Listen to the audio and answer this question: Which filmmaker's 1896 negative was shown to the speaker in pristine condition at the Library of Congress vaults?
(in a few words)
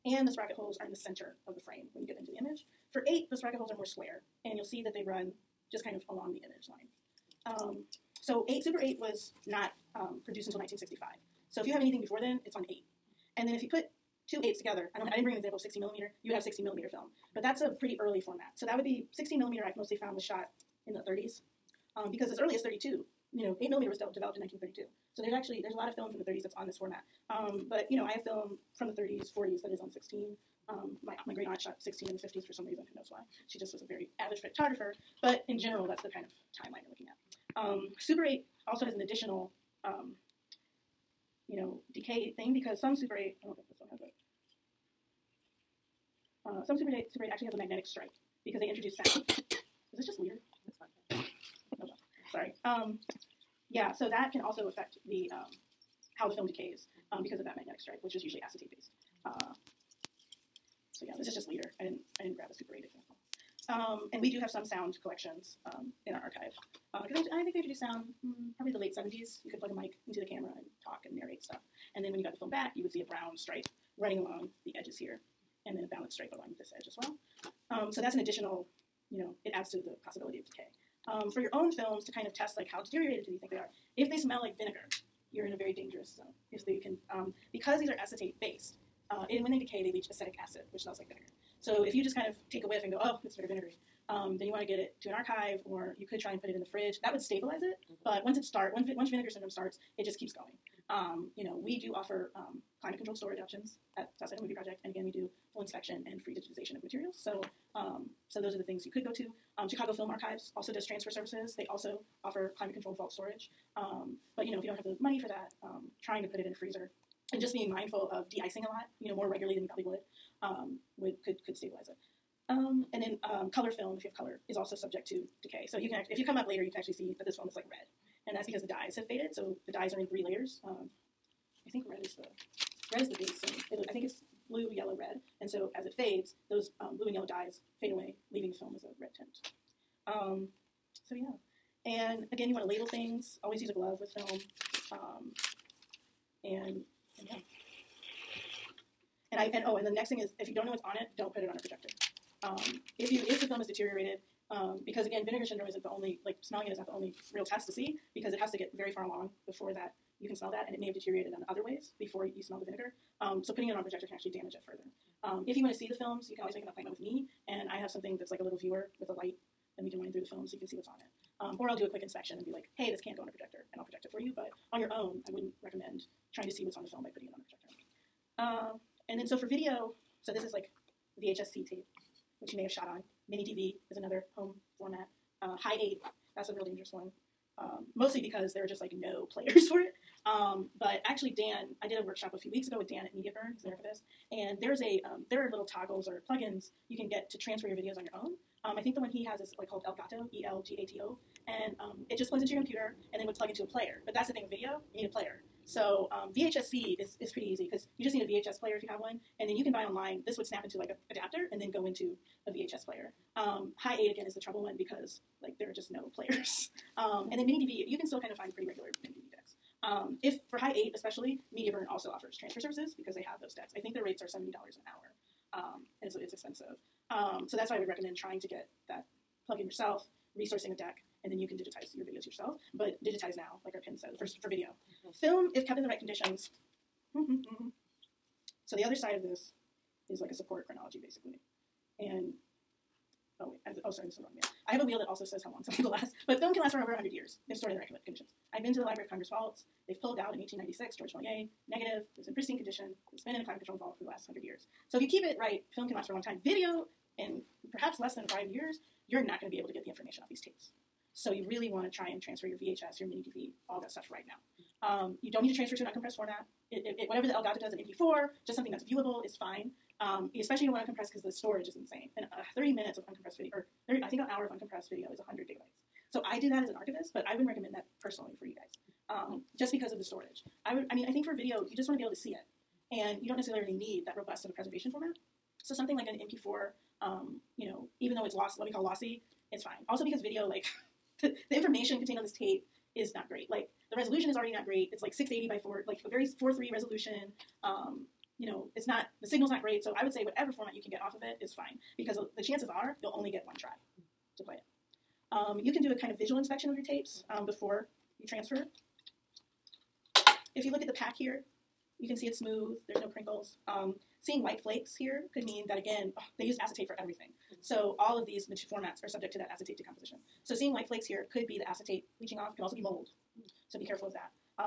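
Georges Méliès.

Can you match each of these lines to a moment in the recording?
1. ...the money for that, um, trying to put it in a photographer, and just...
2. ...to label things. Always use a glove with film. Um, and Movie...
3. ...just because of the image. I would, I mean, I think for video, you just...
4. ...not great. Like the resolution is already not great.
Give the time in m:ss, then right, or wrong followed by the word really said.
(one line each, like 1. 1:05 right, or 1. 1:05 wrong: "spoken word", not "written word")
1. 1:54 wrong: "freezer", not "photographer"
2. 2:22 wrong: "And", not "Movie"
3. 4:39 wrong: "storage", not "image"
4. 4:53 right.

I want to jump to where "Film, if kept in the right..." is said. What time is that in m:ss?
3:55.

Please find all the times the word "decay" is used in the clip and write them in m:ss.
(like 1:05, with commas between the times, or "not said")
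0:41, 0:56, 1:20, 1:29, 2:05.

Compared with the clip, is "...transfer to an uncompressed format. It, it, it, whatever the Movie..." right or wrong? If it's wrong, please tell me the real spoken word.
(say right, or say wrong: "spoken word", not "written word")
wrong: "Elgato", not "Movie".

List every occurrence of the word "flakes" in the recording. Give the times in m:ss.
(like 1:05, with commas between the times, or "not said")
5:14, 5:20.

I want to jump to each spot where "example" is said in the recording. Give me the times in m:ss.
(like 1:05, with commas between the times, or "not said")
0:15, 1:02.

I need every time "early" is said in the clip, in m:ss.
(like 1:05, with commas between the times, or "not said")
0:17, 0:22.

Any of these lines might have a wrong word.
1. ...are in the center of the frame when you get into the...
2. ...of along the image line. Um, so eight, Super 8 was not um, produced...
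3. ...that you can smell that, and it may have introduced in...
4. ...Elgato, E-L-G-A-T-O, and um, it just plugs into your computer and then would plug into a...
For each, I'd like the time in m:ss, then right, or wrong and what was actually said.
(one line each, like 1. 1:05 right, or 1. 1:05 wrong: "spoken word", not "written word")
1. 0:00 right
2. 0:05 right
3. 2:39 wrong: "deteriorated", not "introduced"
4. 3:19 right.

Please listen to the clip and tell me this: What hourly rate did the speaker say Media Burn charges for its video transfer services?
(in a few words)
$70 an hour.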